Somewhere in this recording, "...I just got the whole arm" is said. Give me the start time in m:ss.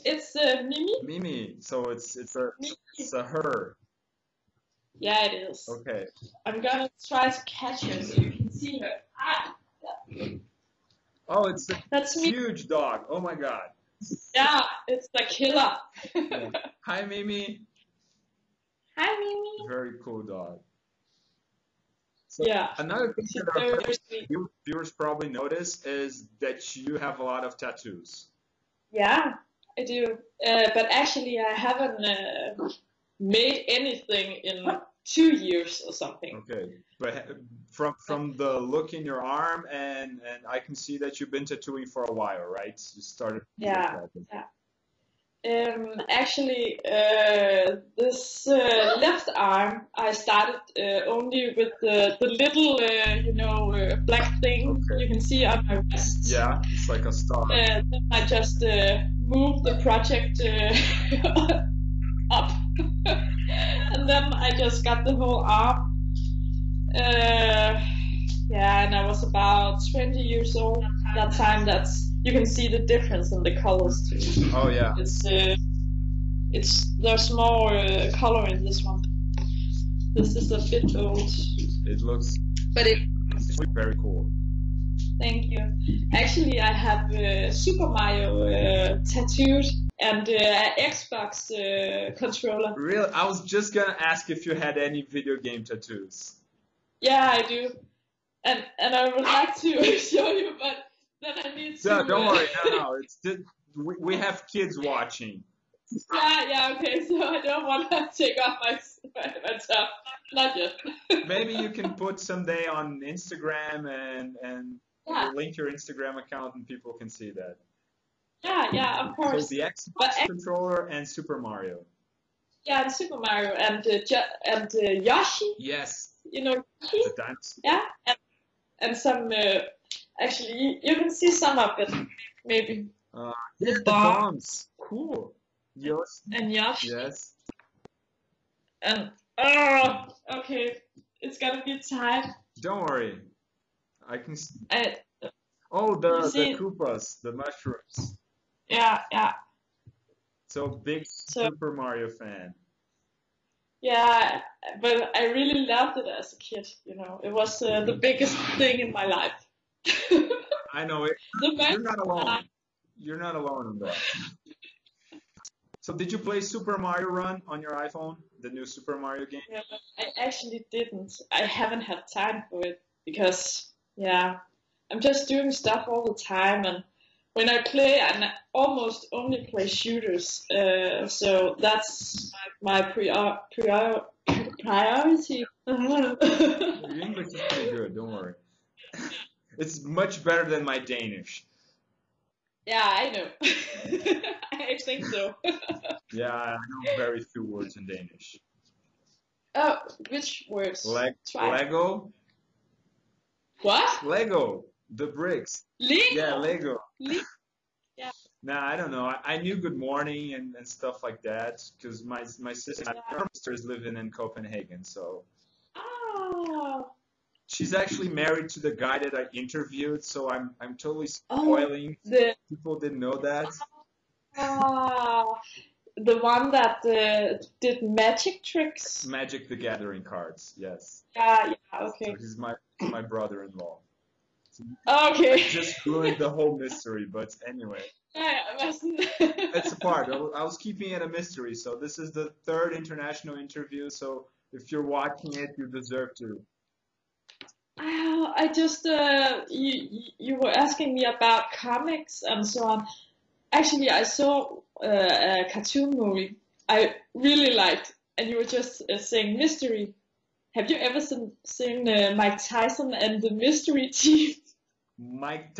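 1:04.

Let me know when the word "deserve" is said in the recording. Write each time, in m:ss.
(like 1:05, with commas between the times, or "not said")
4:05.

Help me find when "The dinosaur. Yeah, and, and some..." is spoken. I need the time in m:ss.
2:07.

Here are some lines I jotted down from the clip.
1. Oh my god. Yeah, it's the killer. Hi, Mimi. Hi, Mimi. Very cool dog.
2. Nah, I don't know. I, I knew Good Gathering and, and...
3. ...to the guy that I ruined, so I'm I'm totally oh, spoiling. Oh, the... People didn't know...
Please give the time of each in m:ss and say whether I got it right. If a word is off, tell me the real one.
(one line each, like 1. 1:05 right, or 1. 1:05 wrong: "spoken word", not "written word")
1. 0:13 right
2. 3:28 wrong: "Morning", not "Gathering"
3. 3:38 wrong: "interviewed", not "ruined".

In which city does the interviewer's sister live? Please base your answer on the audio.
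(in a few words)
Copenhagen.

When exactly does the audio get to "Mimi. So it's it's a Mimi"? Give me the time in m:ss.
0:01.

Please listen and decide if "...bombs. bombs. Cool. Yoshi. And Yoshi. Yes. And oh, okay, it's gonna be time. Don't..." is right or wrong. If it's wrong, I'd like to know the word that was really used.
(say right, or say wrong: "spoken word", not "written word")
right.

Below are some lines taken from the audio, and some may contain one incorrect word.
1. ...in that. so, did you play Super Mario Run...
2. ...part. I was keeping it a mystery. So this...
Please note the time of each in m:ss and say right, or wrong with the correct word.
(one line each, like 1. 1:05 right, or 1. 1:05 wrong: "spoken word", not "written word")
1. 2:43 right
2. 3:59 right.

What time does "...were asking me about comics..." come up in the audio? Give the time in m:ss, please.
4:10.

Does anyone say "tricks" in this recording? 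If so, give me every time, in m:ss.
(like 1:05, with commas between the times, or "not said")
3:48.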